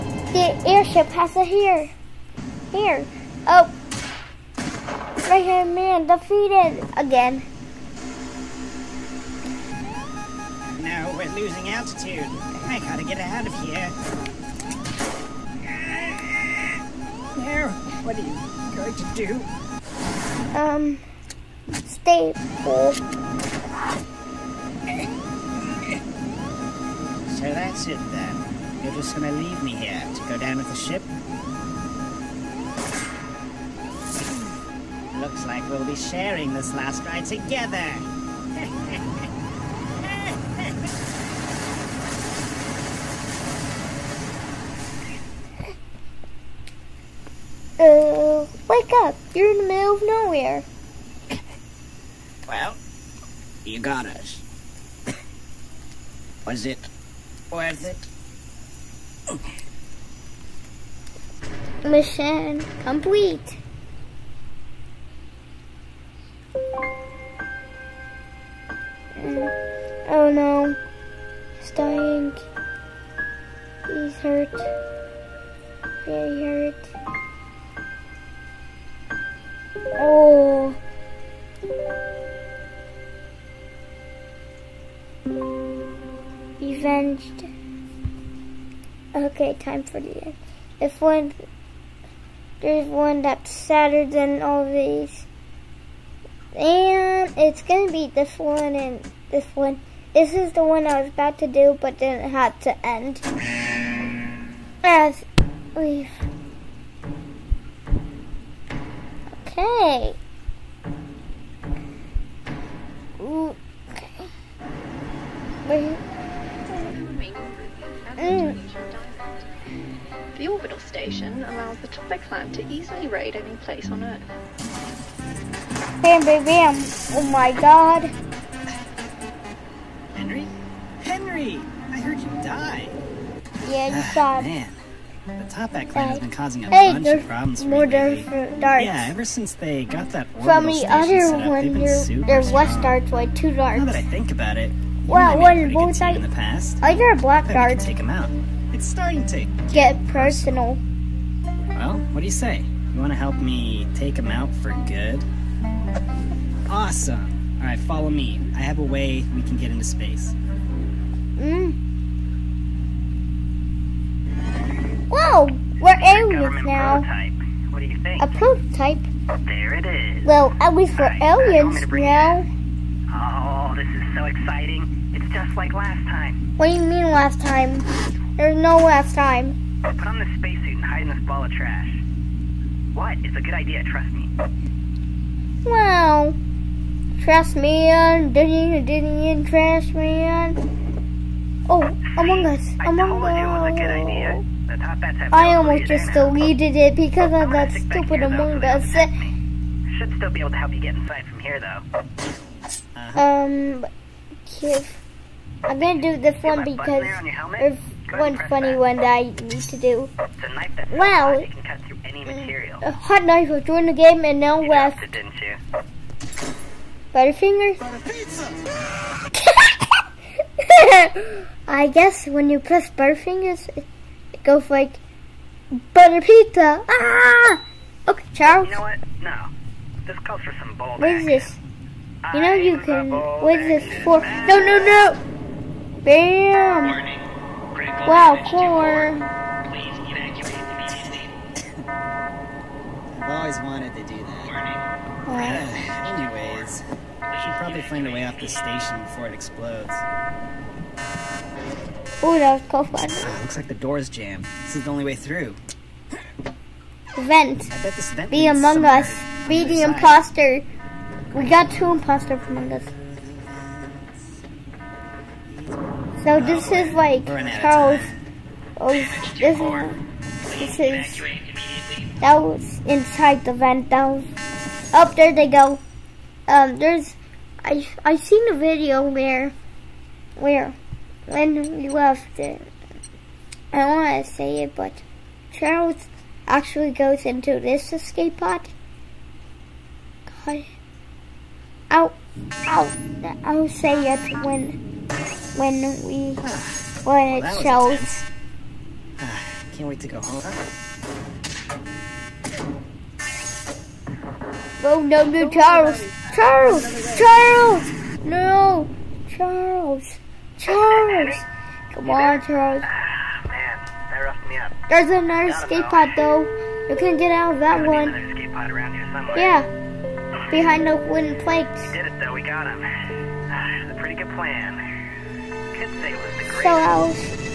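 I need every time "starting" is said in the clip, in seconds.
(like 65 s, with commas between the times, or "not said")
148 s.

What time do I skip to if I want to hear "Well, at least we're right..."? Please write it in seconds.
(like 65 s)
170 s.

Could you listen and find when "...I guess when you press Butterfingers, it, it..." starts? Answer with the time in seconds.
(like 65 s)
221 s.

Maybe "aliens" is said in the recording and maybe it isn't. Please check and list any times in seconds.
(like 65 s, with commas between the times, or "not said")
166 s, 171 s.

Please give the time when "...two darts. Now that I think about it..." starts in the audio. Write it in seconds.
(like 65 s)
143 s.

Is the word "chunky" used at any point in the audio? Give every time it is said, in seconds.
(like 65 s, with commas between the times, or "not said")
not said.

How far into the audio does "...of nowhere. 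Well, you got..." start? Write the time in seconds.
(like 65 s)
49 s.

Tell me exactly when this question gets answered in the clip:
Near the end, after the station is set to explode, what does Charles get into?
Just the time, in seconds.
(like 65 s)
287 s.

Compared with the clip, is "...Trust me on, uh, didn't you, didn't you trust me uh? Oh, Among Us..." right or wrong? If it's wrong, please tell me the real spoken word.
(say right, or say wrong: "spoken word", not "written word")
right.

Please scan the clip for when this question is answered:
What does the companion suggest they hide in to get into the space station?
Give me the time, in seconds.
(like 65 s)
181 s.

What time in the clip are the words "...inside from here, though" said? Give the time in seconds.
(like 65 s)
200 s.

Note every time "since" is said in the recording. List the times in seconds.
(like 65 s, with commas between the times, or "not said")
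139 s.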